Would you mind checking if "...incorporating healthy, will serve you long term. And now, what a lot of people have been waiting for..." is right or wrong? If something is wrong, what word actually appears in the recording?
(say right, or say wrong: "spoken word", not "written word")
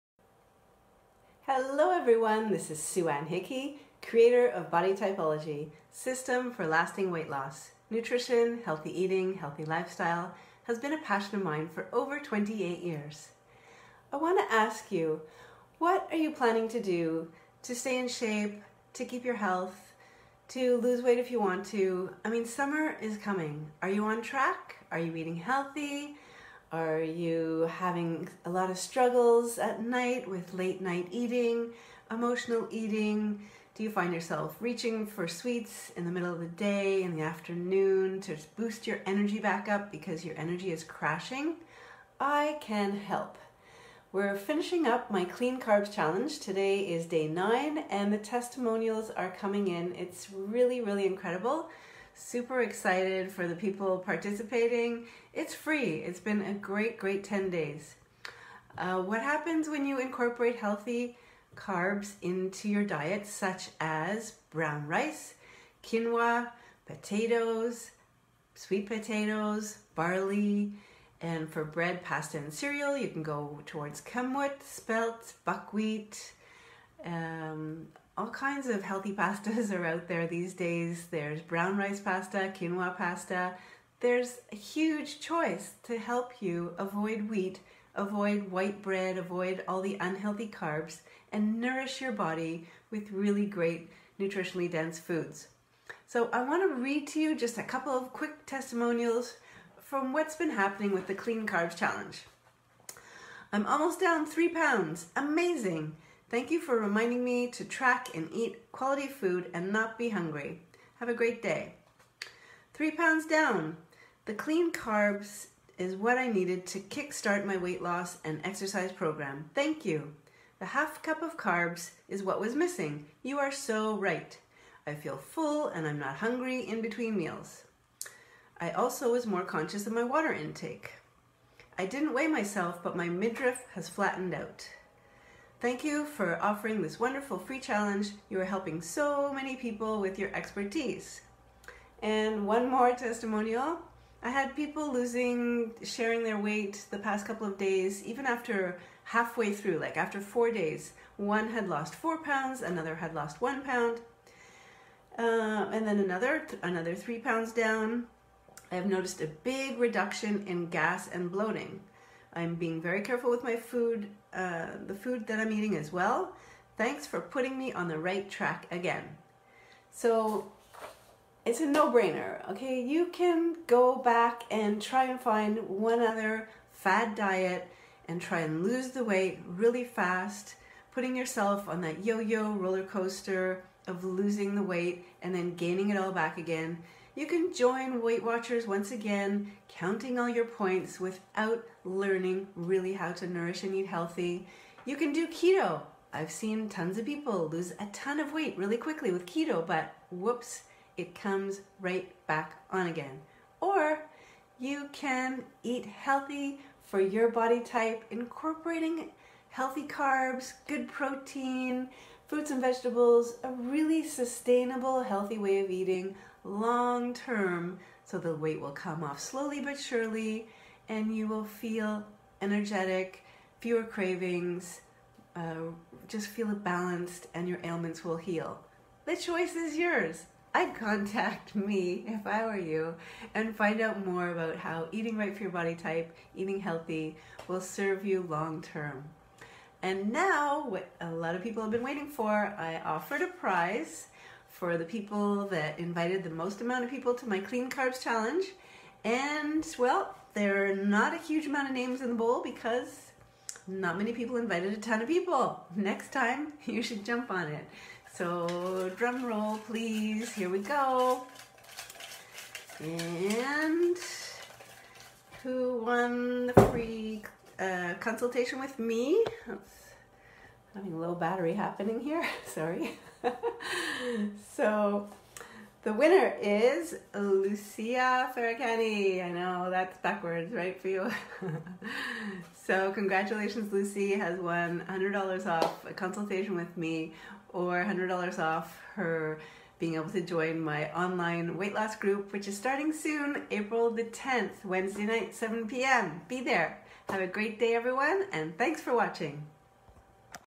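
wrong: "eating", not "incorporating".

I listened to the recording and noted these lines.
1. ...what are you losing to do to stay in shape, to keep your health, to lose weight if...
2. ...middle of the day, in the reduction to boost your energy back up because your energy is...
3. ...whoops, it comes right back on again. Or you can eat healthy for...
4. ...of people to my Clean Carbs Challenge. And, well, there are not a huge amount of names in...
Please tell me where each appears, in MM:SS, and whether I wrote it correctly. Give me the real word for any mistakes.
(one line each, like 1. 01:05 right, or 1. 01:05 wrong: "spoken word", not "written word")
1. 00:15 wrong: "planning", not "losing"
2. 00:36 wrong: "afternoon", not "reduction"
3. 03:20 right
4. 04:06 right.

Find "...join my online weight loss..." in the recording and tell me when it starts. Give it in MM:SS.
04:50.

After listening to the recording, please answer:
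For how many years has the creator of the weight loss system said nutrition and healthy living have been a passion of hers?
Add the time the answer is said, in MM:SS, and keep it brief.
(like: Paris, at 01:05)
28, at 00:12.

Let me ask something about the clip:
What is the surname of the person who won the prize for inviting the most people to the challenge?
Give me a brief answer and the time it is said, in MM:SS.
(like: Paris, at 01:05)
Ferracani, at 04:38.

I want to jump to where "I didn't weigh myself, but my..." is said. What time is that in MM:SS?
02:11.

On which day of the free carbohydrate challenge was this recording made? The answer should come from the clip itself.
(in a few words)
day 9.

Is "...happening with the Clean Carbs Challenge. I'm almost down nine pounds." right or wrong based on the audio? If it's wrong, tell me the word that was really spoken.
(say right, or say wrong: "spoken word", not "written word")
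wrong: "three", not "nine".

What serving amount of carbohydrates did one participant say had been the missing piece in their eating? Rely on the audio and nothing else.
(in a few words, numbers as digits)
half cup.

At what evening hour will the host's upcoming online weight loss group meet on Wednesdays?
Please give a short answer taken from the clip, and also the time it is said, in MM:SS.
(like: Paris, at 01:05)
7 p.m., at 04:55.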